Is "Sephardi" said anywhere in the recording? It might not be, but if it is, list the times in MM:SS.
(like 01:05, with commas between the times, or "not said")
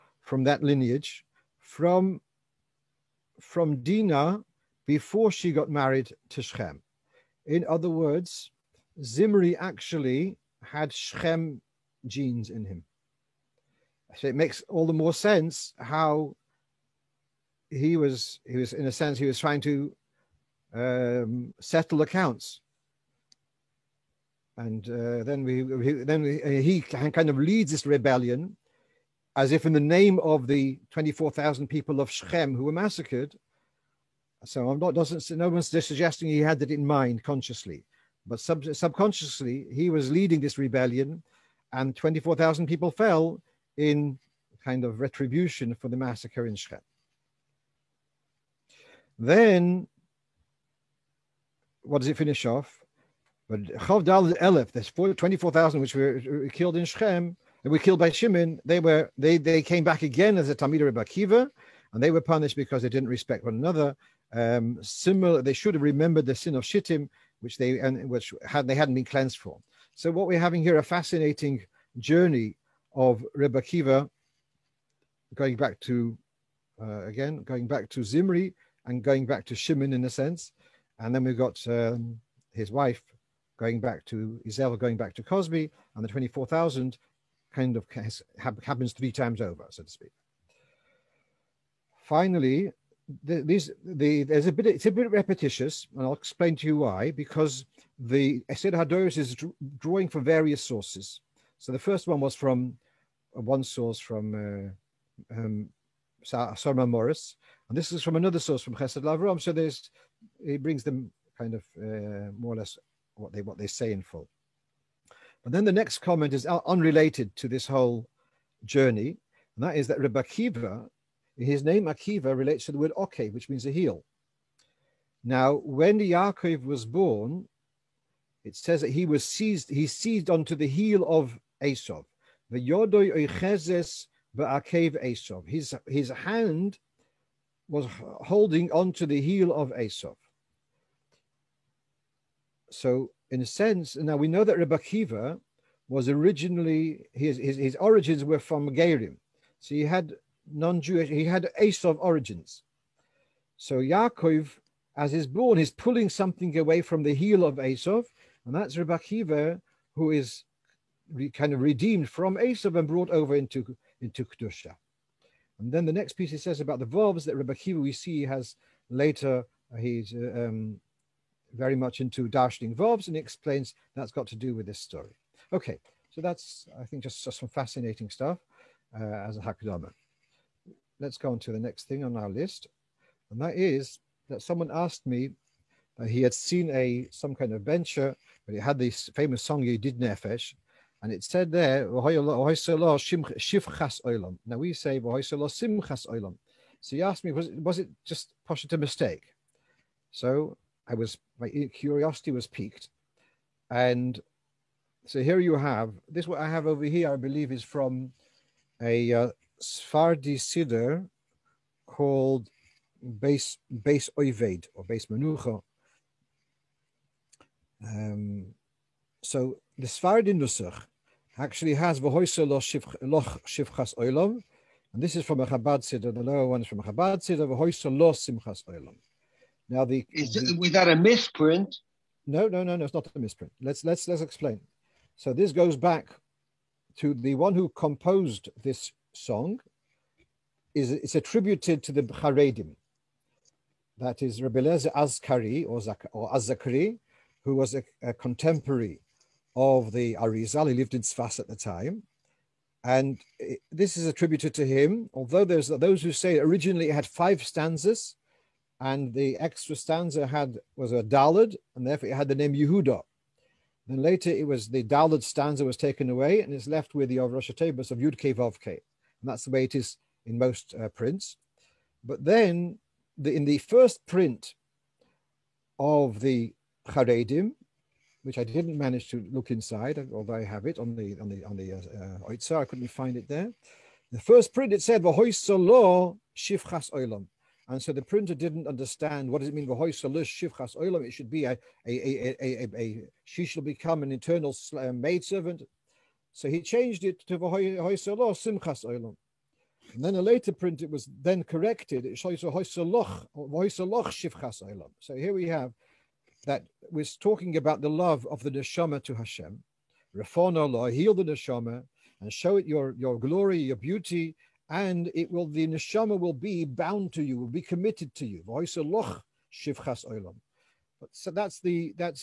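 03:29, 03:39.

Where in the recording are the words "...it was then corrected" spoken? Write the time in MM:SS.
05:00.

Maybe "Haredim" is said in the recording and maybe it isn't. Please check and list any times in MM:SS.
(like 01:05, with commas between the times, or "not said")
04:02, 04:36.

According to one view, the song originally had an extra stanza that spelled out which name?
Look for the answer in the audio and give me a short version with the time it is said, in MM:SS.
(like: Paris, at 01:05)
Yehuda, at 04:22.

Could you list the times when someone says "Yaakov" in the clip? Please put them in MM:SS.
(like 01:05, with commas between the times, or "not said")
02:05, 02:33.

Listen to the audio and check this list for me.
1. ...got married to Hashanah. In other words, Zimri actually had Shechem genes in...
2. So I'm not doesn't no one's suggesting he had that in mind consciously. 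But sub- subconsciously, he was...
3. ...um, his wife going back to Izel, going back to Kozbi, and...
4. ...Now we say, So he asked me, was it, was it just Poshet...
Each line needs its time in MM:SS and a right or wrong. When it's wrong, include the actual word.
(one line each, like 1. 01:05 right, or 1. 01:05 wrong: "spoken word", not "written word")
1. 00:05 wrong: "Shem", not "Hashanah"
2. 00:34 right
3. 01:21 right
4. 03:11 right.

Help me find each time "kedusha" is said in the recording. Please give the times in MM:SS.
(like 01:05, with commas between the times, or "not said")
02:44.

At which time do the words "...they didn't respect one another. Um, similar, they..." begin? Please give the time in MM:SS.
01:02.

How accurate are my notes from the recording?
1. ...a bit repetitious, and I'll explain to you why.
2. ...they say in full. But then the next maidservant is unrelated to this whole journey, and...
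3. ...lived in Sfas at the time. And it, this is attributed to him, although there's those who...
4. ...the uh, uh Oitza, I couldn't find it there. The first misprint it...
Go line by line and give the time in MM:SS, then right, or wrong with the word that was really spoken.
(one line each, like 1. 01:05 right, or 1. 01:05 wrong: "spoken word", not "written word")
1. 01:34 right
2. 01:53 wrong: "comment", not "maidservant"
3. 04:10 right
4. 04:41 wrong: "print", not "misprint".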